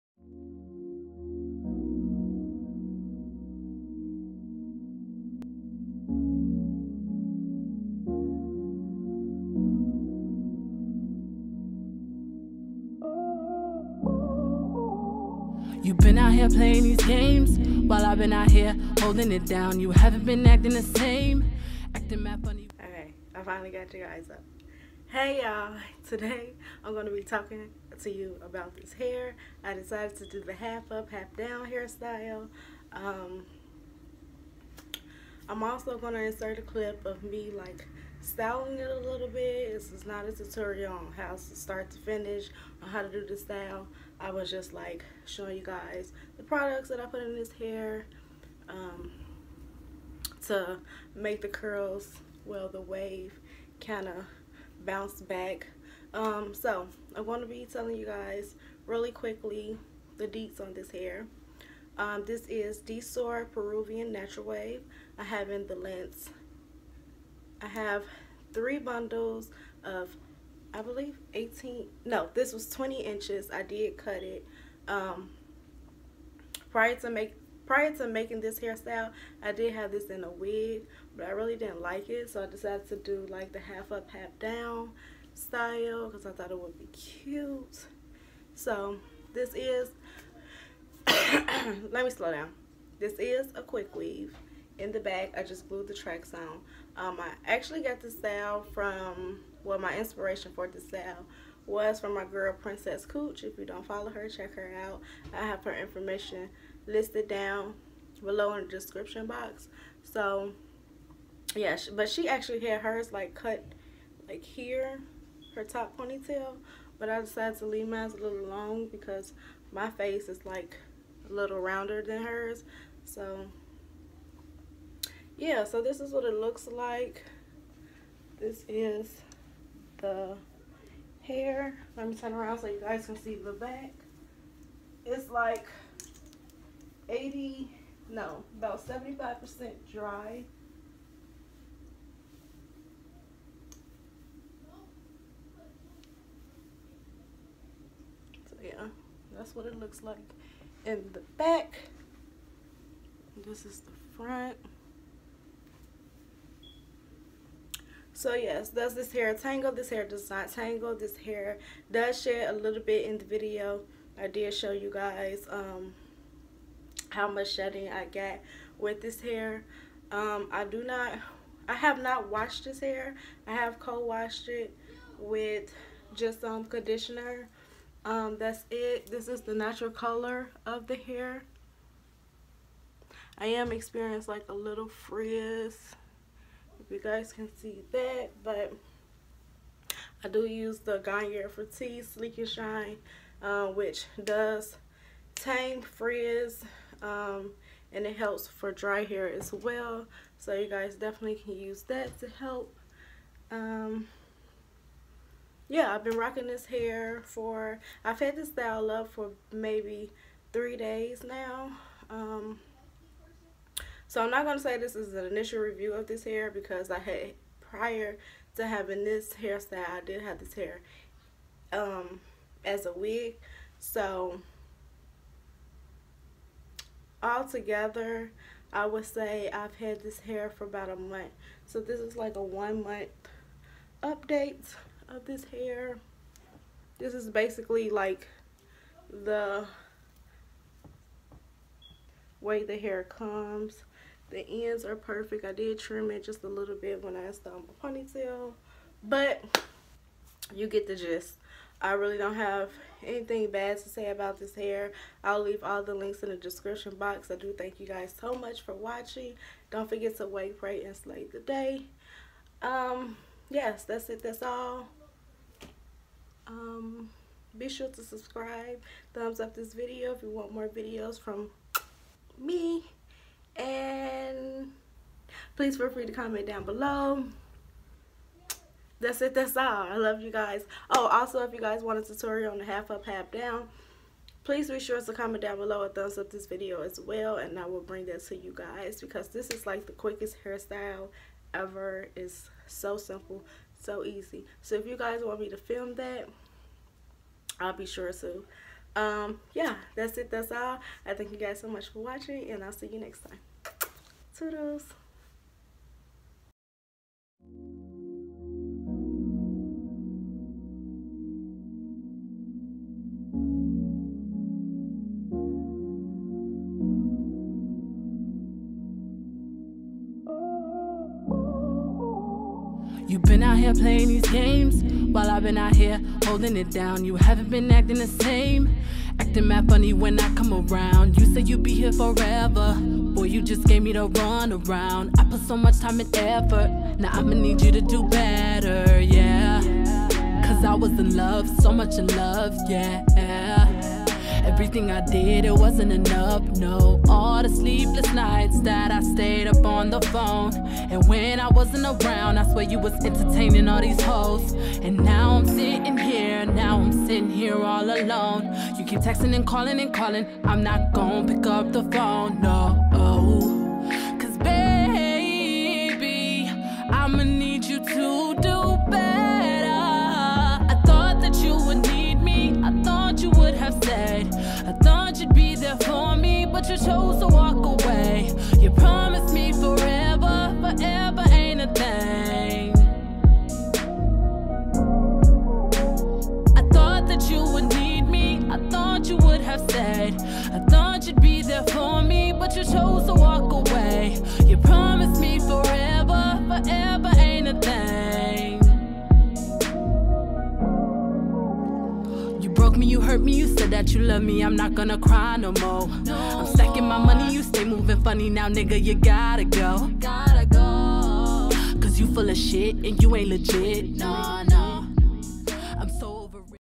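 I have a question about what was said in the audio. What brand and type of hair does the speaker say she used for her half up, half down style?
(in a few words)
DSOAR Peruvian Natural Wave.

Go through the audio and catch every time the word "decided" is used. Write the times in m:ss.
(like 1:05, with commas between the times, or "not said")
0:29, 1:22, 1:57.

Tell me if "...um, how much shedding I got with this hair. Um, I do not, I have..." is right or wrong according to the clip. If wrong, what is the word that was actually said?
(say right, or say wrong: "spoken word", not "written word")
right.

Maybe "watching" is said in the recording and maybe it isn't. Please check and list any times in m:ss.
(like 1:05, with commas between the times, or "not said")
4:18, 5:01.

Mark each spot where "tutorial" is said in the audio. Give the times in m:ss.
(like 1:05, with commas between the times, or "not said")
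0:40, 4:42.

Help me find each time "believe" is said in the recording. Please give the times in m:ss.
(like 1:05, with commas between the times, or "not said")
1:10.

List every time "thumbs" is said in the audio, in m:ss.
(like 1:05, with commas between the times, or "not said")
4:29, 4:45.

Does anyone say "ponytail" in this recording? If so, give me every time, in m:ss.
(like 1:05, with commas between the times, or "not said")
1:55, 4:07.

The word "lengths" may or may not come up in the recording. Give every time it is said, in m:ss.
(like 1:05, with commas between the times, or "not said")
1:05.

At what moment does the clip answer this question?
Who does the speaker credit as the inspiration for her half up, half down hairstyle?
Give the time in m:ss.
1:42.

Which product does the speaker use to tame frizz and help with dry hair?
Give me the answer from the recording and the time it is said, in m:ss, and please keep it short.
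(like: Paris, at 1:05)
Garnier Fructis Sleek and Shine, at 3:10.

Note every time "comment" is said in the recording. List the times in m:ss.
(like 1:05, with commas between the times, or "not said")
4:36, 4:45.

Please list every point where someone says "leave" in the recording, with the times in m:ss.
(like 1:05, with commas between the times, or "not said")
1:57, 4:15.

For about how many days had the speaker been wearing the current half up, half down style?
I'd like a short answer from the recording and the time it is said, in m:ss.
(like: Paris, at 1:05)
3 days, at 3:30.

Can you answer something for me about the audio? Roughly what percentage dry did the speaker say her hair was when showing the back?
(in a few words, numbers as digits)
75 percent.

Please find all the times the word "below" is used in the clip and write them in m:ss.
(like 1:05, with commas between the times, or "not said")
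1:48, 4:36, 4:45.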